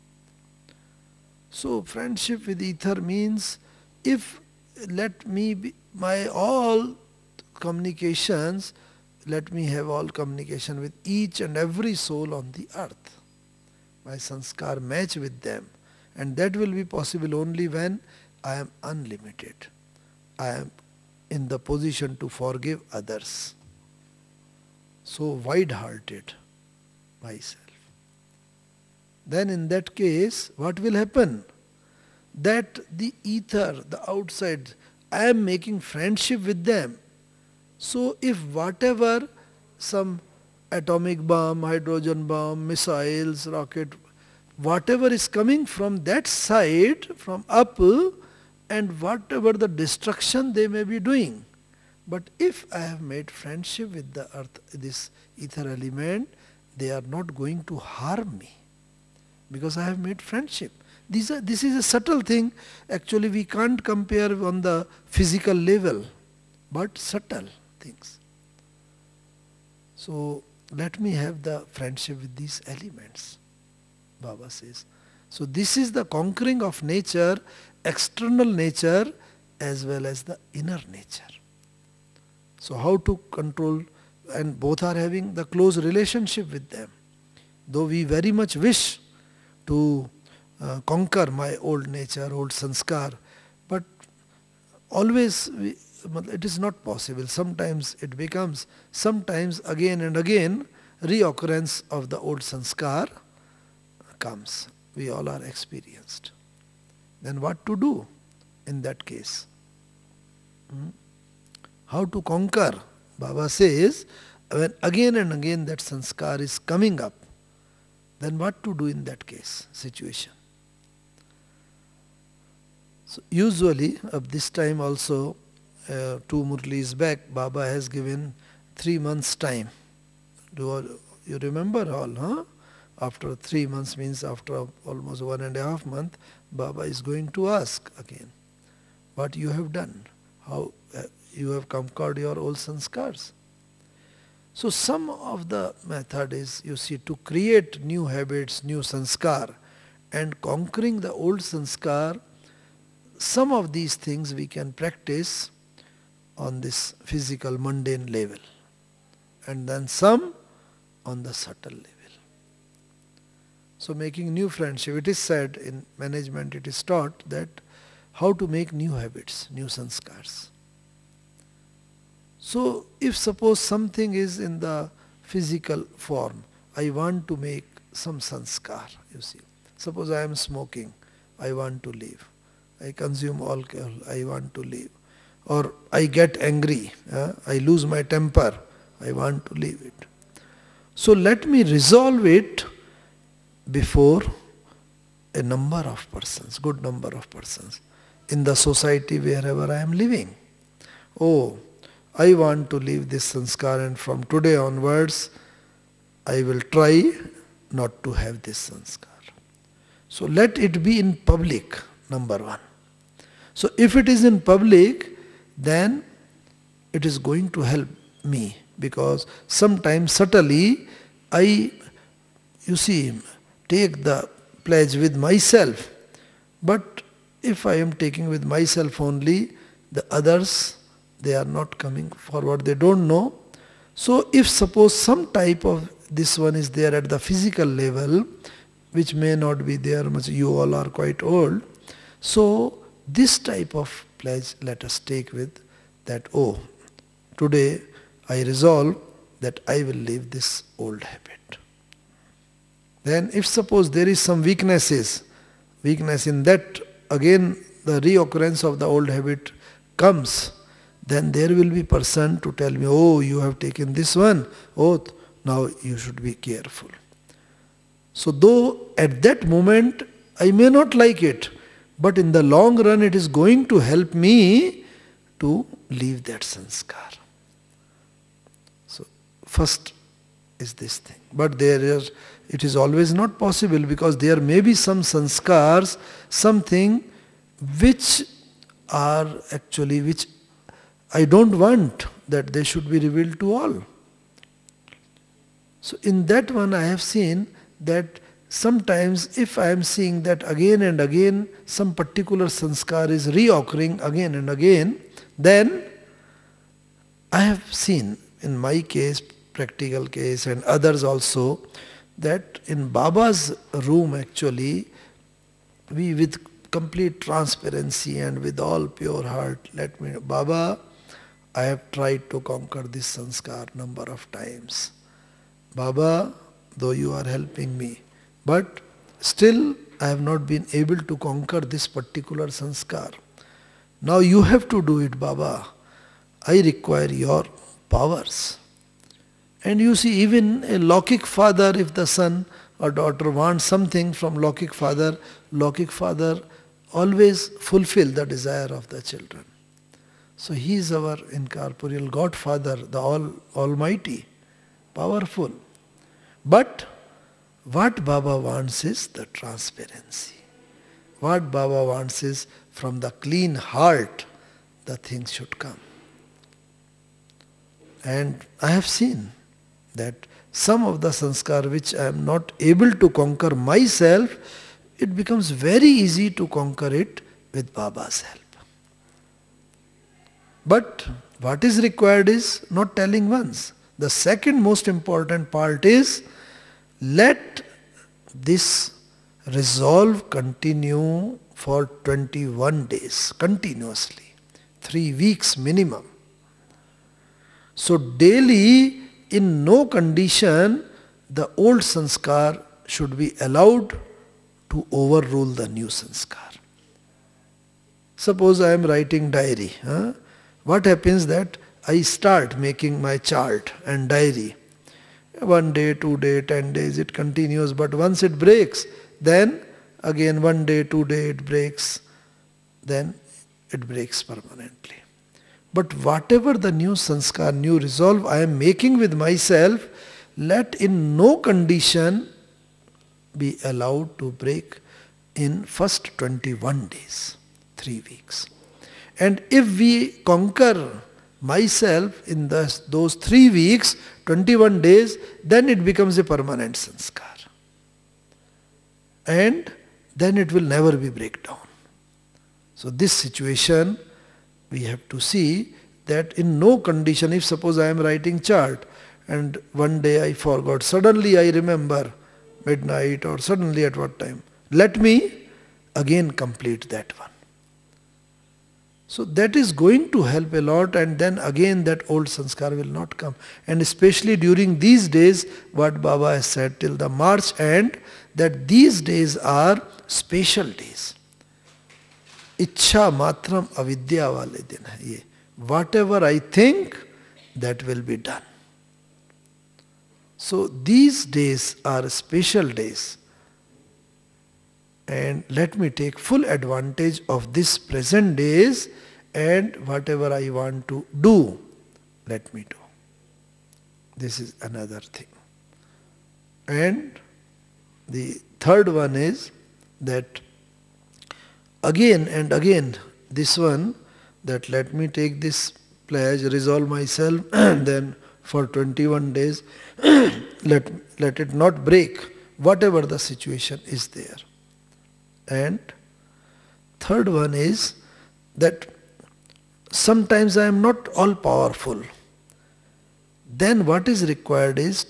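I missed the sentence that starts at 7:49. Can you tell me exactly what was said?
So that is going to help a lot and then again that old sanskar will not come.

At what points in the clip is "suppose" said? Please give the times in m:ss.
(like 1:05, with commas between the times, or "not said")
2:53, 2:59, 3:54, 4:13, 6:48, 7:37.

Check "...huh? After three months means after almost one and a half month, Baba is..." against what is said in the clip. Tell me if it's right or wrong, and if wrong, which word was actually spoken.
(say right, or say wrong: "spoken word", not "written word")
right.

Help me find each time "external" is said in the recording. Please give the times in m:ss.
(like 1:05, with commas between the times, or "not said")
1:17.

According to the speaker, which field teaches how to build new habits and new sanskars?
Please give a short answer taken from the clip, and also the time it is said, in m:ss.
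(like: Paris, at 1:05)
Management, at 2:45.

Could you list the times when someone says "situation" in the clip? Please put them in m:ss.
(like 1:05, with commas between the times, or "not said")
1:59, 7:33, 8:43.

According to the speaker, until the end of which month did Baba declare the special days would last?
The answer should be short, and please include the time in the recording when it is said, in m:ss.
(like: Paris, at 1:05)
March, at 7:57.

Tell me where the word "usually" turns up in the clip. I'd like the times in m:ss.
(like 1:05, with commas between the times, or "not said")
2:03.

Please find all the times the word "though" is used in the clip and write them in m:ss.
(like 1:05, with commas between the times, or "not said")
1:27, 4:28, 5:26.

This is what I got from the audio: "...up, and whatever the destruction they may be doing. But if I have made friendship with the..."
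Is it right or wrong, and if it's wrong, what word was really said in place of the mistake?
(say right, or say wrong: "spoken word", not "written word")
right.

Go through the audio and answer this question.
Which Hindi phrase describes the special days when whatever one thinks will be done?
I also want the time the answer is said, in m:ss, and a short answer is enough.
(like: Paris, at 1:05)
Ichha matram avidya, at 8:02.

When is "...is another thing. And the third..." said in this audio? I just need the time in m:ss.
8:24.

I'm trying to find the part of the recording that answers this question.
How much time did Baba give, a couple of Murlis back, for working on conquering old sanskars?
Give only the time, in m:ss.
2:08.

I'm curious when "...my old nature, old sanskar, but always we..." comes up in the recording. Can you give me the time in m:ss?
1:31.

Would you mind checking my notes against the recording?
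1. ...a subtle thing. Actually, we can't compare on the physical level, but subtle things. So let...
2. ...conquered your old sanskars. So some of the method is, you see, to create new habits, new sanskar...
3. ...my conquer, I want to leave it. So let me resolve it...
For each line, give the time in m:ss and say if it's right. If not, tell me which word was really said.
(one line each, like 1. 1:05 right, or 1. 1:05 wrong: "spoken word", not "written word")
1. 1:01 right
2. 2:21 right
3. 3:07 wrong: "temper", not "conquer".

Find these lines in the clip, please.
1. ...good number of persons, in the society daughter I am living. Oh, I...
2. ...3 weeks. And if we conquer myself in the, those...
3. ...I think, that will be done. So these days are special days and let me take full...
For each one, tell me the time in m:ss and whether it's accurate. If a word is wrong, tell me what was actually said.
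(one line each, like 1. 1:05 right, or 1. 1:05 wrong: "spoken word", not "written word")
1. 3:16 wrong: "wherever", not "daughter"
2. 7:17 right
3. 8:06 right.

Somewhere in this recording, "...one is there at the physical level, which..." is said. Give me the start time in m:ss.
3:56.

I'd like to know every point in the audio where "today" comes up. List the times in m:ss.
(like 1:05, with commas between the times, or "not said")
3:24, 4:07.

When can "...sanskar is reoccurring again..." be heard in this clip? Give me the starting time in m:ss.
5:02.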